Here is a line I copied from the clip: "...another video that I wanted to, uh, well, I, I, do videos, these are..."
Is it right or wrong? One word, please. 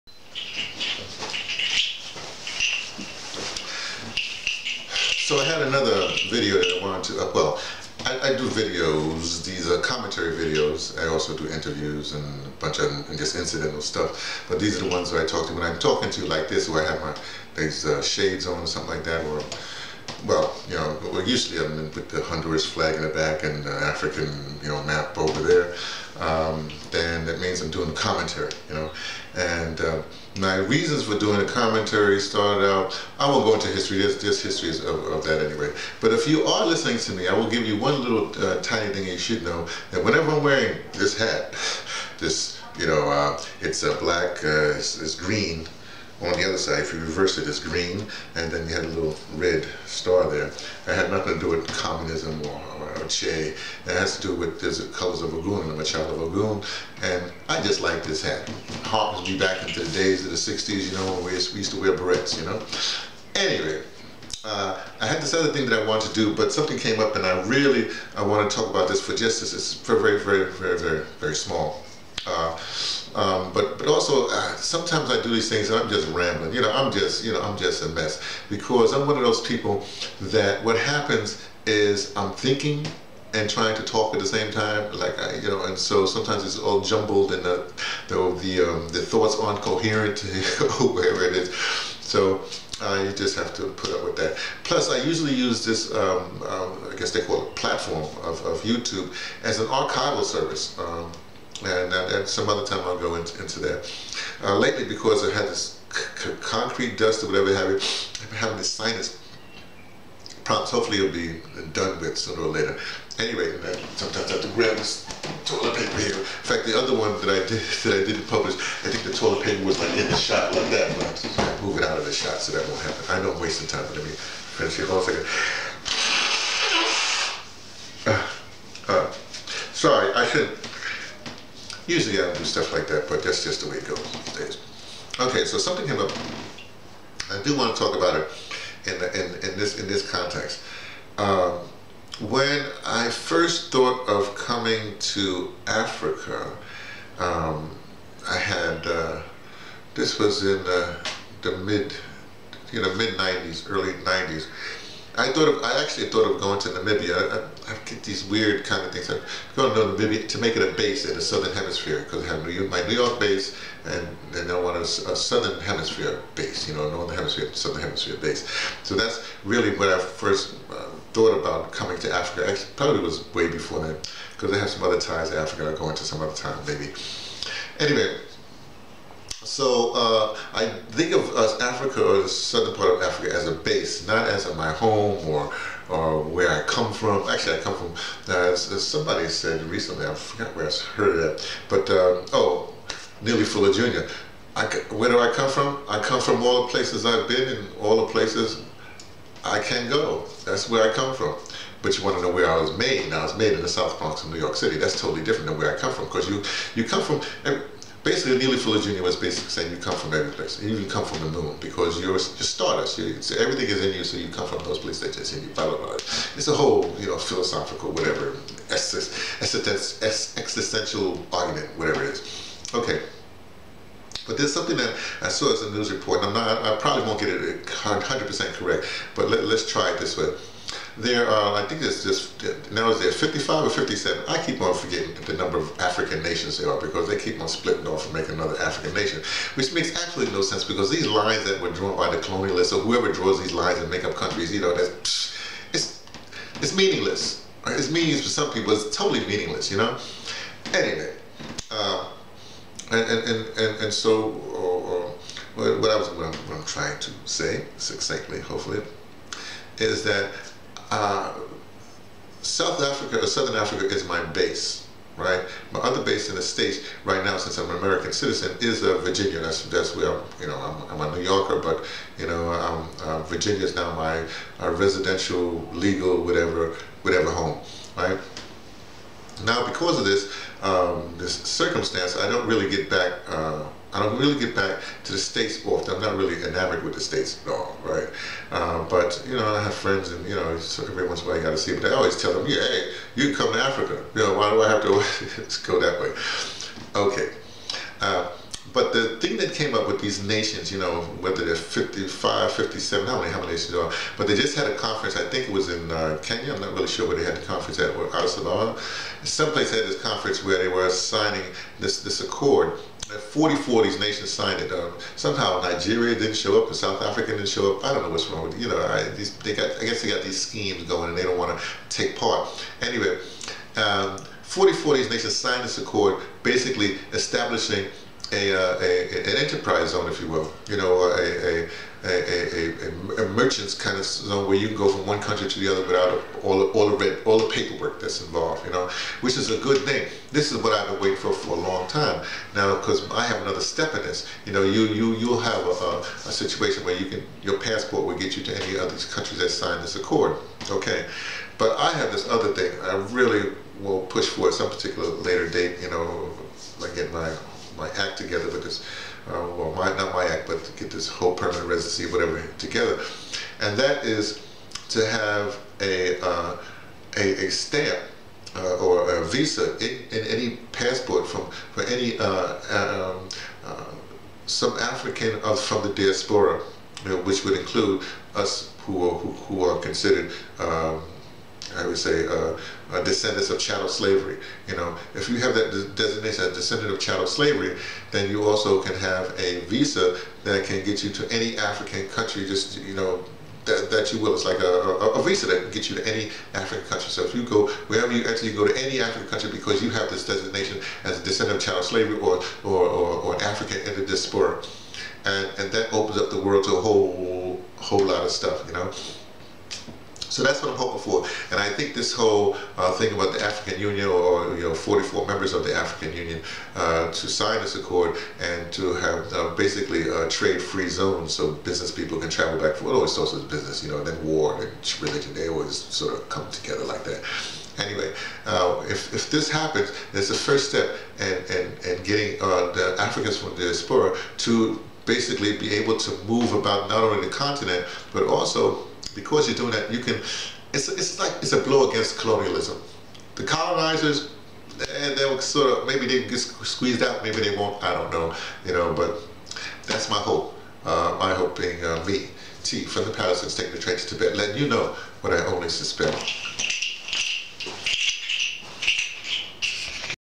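right.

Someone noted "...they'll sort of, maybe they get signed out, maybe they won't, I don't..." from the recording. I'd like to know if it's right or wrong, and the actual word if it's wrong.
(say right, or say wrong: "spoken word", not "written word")
wrong: "squeezed", not "signed".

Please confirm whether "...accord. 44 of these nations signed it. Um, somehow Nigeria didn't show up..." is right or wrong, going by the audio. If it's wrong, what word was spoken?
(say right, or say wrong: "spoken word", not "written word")
right.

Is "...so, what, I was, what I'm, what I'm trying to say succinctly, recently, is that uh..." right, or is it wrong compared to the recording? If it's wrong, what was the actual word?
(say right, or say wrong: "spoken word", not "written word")
wrong: "hopefully", not "recently".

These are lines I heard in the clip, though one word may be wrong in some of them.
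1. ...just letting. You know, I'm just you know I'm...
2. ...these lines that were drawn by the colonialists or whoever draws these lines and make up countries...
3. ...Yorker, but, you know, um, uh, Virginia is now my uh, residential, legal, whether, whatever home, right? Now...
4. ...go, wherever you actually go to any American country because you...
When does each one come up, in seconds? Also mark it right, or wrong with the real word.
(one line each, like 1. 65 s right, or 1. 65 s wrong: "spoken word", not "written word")
1. 75 s wrong: "rambling", not "letting"
2. 240 s right
3. 271 s wrong: "whatever", not "whether"
4. 397 s wrong: "African", not "American".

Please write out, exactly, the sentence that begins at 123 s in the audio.
I know I'm wasting time, but let me finish here.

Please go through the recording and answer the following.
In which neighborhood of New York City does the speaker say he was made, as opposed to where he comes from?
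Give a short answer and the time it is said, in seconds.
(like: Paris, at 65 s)
South Bronx, at 203 s.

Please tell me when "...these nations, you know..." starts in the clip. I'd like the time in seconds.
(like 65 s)
299 s.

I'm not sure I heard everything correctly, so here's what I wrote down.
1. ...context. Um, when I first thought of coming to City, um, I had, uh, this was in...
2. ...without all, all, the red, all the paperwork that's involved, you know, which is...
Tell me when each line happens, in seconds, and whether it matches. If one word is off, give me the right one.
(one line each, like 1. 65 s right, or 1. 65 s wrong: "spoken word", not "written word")
1. 140 s wrong: "Africa", not "City"
2. 335 s right.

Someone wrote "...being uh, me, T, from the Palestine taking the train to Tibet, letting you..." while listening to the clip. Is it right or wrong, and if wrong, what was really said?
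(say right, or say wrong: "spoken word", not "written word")
right.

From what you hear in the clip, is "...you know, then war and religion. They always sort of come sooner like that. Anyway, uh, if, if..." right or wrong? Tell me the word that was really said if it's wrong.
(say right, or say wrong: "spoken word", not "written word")
wrong: "together", not "sooner".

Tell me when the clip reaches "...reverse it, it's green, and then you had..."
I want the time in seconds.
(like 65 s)
46 s.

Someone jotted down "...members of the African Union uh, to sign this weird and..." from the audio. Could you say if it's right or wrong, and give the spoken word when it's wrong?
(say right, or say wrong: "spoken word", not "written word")
wrong: "accord", not "weird".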